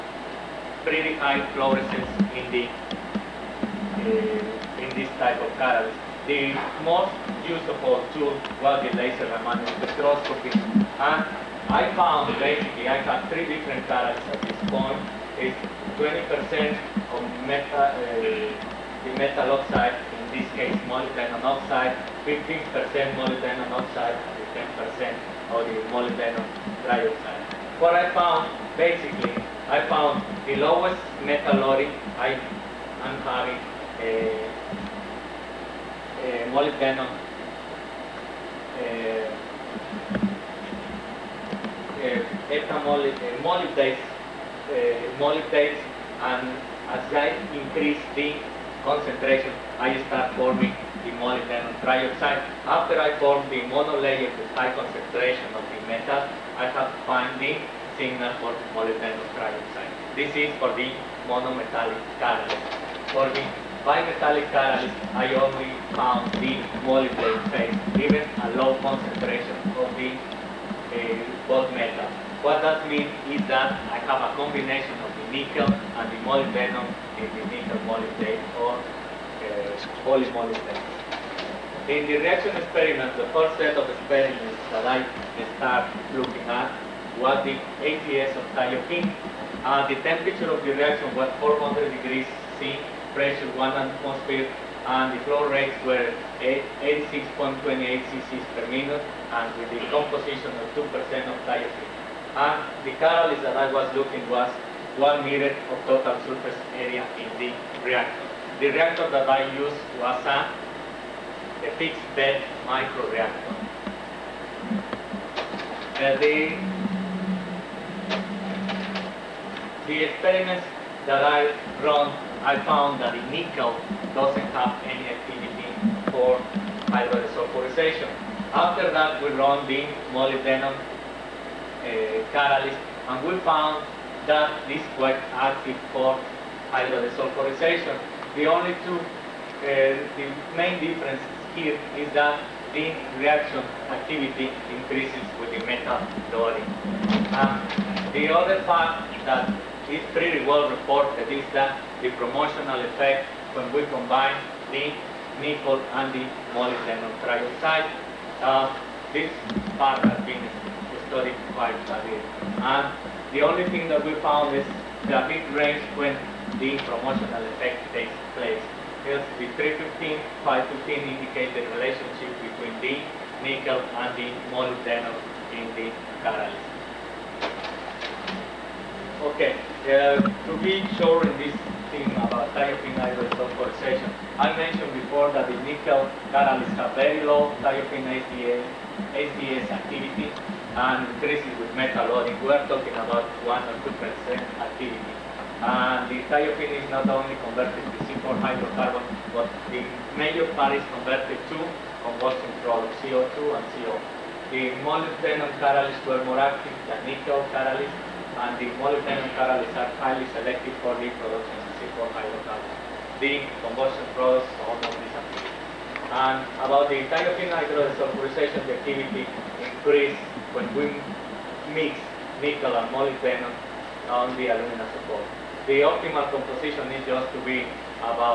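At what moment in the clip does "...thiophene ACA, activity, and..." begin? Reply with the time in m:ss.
3:07.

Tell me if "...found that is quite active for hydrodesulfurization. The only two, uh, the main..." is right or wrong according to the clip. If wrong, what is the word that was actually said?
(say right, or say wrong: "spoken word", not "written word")
right.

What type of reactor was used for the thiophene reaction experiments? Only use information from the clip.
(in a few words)
Fixed bed microreactor.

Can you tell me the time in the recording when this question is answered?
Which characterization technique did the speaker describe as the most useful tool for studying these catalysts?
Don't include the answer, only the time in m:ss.
0:08.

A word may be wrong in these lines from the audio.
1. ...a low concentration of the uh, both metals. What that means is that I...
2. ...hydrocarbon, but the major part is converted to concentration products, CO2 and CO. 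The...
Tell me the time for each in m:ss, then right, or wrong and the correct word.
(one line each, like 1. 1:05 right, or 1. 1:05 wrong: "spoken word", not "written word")
1. 1:08 right
2. 3:18 wrong: "combustion", not "concentration".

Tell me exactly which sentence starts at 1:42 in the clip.
And the catalyst that I was looking was 1 meter of total surface area in the reactor.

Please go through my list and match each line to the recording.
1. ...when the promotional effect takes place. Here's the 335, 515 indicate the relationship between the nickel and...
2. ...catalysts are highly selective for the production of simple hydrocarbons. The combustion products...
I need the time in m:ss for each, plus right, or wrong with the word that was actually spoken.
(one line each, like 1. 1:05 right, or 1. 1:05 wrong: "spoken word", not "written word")
1. 2:45 wrong: "315", not "335"
2. 3:29 right.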